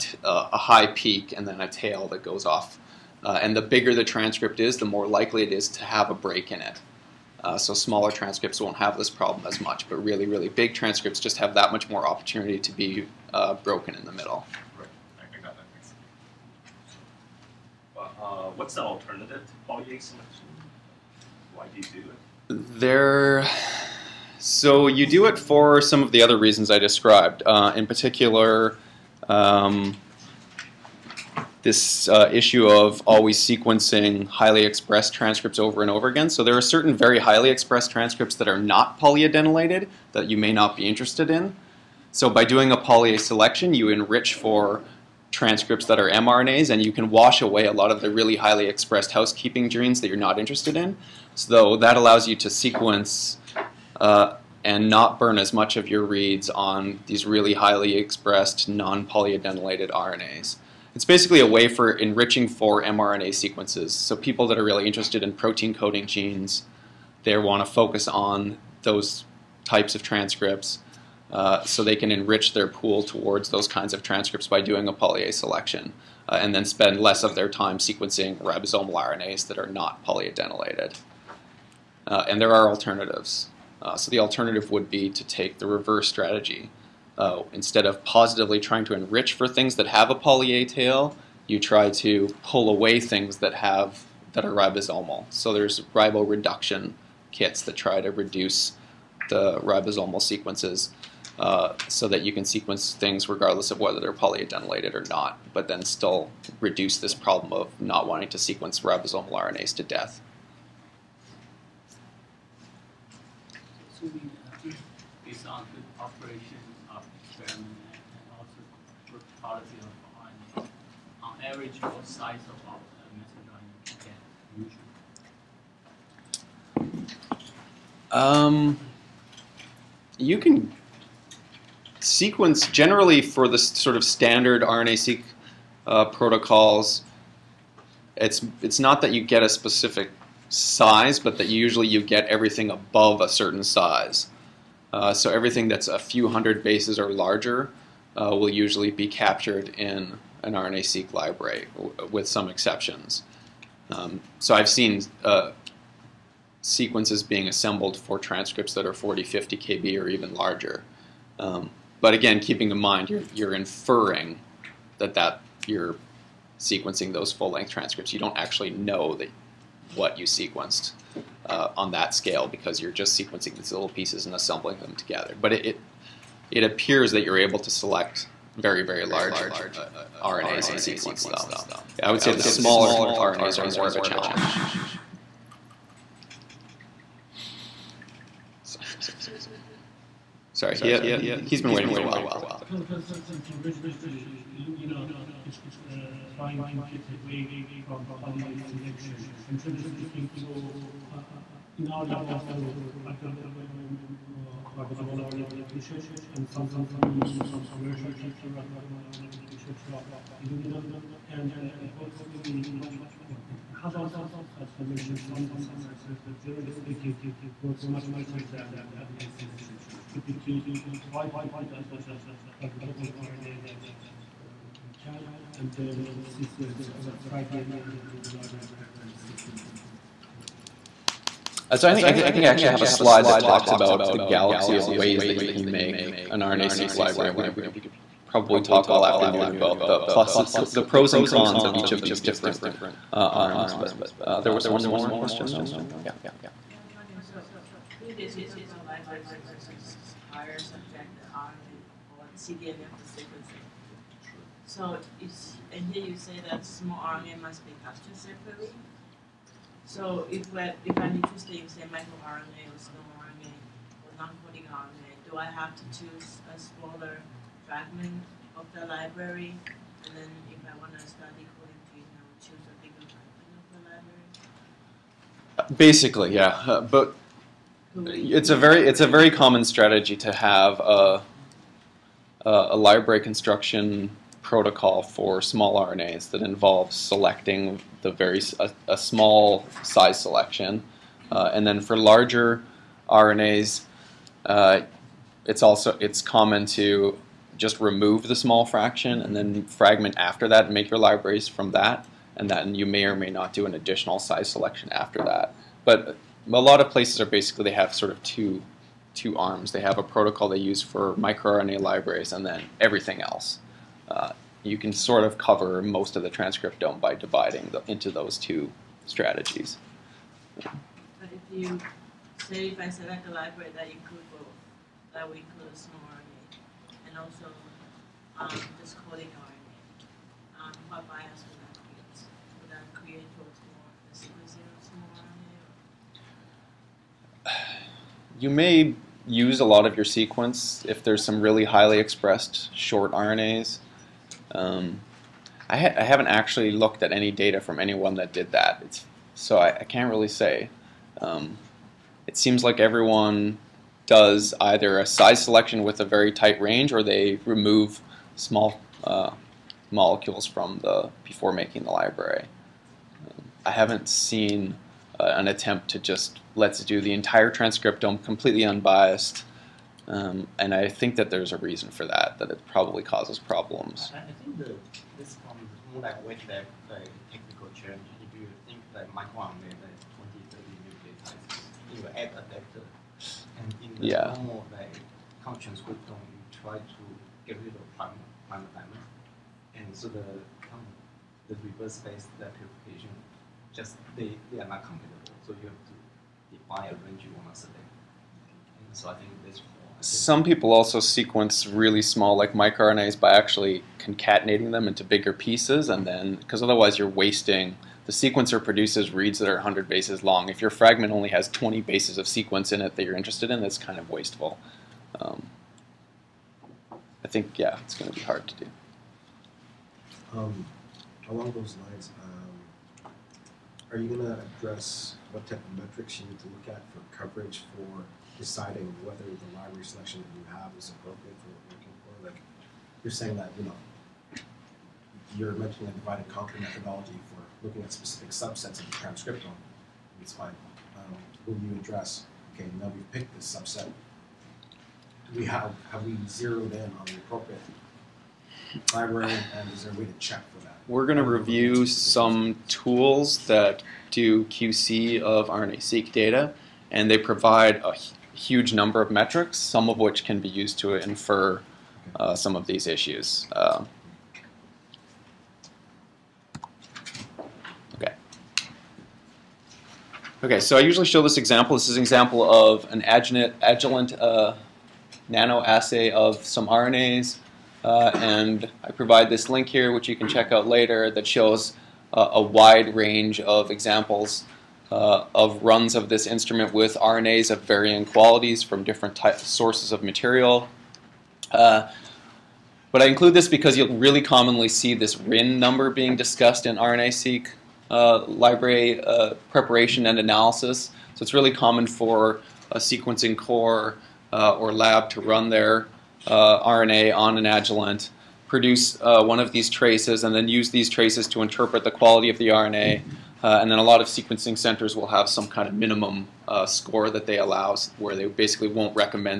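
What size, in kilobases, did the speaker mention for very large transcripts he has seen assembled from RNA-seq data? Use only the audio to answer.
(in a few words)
40, 50 kb.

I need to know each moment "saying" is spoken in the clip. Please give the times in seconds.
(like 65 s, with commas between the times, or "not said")
433 s.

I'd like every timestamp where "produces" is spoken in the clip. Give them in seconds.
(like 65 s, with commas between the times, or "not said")
408 s, 508 s.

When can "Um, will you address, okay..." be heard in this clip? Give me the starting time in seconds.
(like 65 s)
440 s.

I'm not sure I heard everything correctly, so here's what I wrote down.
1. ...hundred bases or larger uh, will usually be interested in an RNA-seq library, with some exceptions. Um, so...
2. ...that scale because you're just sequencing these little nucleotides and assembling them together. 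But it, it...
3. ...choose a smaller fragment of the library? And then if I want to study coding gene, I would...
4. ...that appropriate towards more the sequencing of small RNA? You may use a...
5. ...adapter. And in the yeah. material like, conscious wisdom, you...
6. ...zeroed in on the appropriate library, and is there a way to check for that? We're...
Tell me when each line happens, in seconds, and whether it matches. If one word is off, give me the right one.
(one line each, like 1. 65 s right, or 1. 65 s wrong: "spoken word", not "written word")
1. 146 s wrong: "captured", not "interested"
2. 171 s wrong: "pieces", not "nucleotides"
3. 265 s right
4. 332 s wrong: "create", not "appropriate"
5. 382 s wrong: "normal", not "material"
6. 446 s right.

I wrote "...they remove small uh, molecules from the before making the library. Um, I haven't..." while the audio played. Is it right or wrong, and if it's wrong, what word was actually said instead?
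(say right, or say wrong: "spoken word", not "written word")
right.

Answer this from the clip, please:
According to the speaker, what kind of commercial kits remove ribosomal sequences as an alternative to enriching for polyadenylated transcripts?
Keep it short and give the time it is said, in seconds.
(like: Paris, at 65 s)
Ribo reduction kits, at 95 s.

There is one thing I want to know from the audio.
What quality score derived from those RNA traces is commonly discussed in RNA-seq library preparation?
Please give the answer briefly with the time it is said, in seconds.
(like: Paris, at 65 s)
RIN number, at 495 s.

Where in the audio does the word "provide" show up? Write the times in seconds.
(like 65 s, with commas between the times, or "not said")
457 s, 478 s.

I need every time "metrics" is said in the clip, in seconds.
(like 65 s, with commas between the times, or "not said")
425 s, 459 s.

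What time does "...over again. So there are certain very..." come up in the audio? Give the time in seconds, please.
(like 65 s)
35 s.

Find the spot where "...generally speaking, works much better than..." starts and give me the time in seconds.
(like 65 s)
216 s.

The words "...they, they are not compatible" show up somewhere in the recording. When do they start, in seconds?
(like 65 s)
394 s.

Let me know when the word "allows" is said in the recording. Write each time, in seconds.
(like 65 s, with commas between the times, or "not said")
51 s, 517 s.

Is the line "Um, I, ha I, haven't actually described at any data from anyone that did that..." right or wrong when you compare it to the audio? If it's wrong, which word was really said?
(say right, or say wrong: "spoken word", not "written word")
wrong: "looked", not "described".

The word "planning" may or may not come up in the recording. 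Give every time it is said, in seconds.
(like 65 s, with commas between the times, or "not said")
not said.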